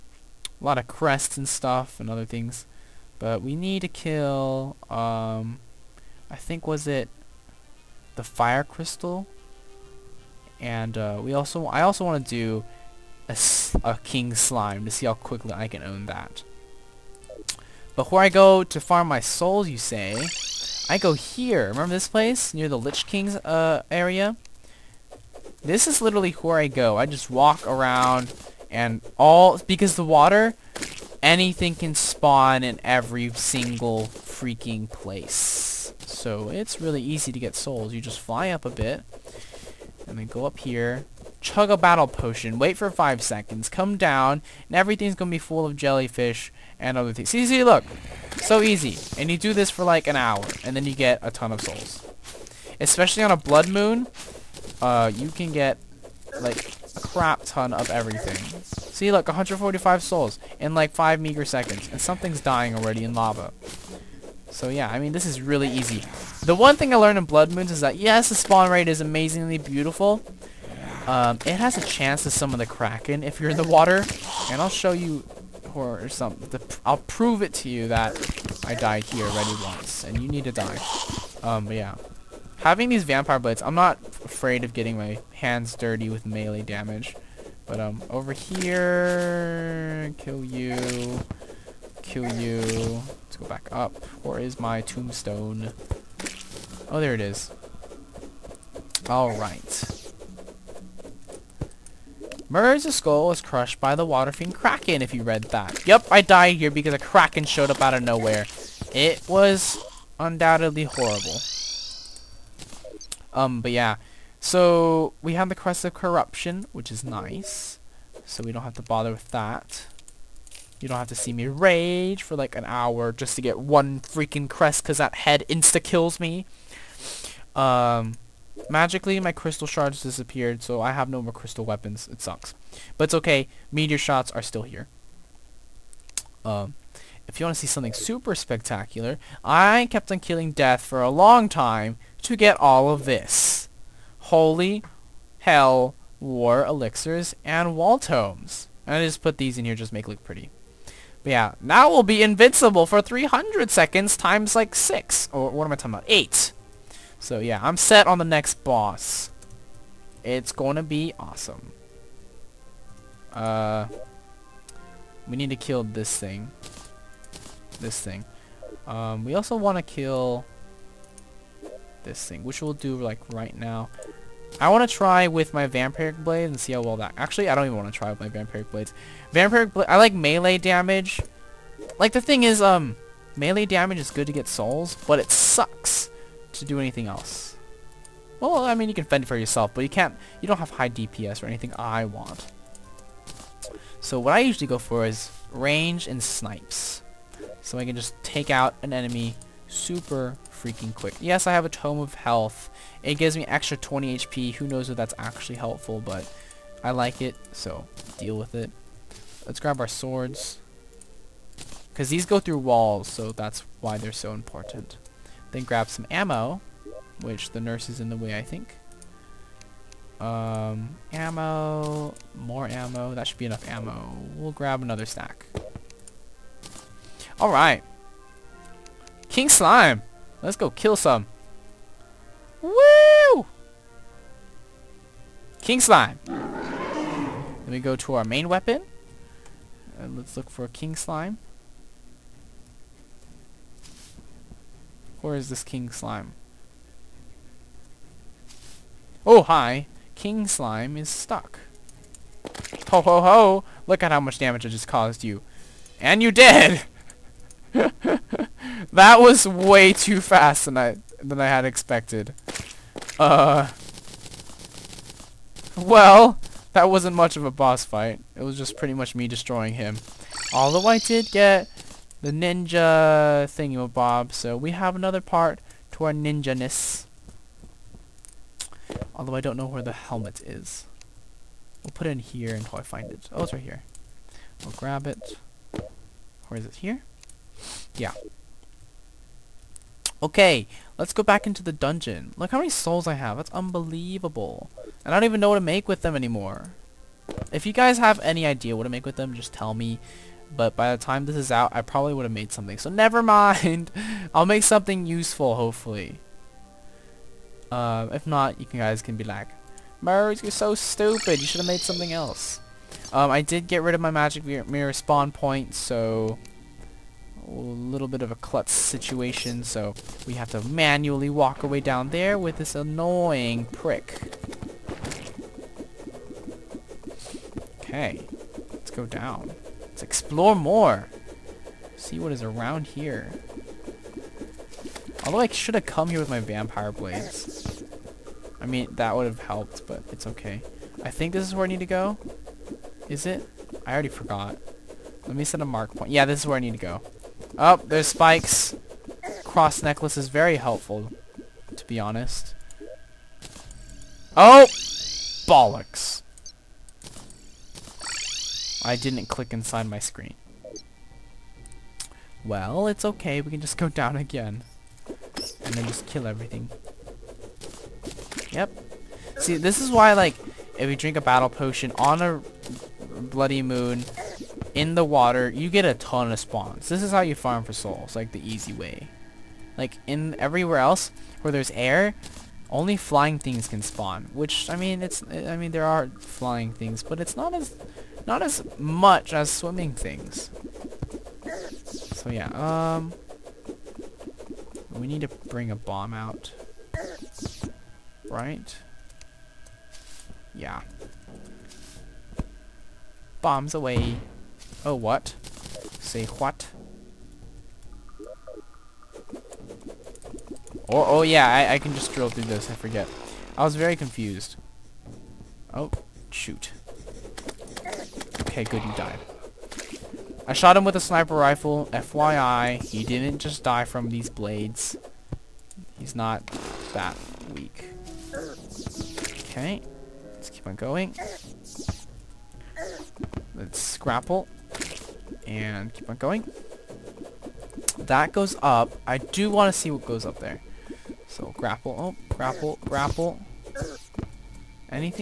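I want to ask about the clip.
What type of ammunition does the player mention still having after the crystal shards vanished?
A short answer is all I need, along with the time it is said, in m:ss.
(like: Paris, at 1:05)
Meteor shots, at 2:13.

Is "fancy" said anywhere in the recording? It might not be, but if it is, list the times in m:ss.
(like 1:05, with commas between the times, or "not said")
not said.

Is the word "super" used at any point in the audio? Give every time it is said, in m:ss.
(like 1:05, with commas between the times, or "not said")
2:17, 3:19.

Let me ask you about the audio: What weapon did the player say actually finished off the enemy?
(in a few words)
sniper rifle.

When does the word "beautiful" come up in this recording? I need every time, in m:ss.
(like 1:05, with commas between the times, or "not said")
1:09.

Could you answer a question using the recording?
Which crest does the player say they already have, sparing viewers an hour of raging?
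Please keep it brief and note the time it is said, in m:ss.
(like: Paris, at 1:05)
Crest of Corruption, at 1:55.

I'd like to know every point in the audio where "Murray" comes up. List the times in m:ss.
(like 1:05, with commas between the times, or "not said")
1:42, 5:10.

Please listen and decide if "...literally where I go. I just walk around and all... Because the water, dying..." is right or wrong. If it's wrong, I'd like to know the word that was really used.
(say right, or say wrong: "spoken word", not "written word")
wrong: "anything", not "dying".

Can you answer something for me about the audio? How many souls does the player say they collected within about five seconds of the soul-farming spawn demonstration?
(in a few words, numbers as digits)
145.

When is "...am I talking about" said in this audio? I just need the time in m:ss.
2:35.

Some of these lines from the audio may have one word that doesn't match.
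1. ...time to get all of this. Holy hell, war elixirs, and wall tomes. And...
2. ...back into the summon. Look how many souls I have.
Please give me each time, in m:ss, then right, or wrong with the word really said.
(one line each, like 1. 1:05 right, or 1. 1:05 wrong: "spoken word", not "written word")
1. 2:21 right
2. 4:51 wrong: "dungeon", not "summon".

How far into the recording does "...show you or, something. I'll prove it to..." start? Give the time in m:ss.
1:14.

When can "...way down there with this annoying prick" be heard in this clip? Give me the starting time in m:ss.
5:21.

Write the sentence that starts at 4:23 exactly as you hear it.
Uh Well, that wasn't much of a boss fight.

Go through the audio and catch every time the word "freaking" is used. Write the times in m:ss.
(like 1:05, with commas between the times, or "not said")
0:34, 2:04, 3:20.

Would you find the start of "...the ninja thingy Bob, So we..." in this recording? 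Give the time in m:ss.
4:32.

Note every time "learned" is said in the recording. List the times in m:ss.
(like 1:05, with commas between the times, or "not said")
1:06.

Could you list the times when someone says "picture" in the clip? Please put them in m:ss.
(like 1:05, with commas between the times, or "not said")
not said.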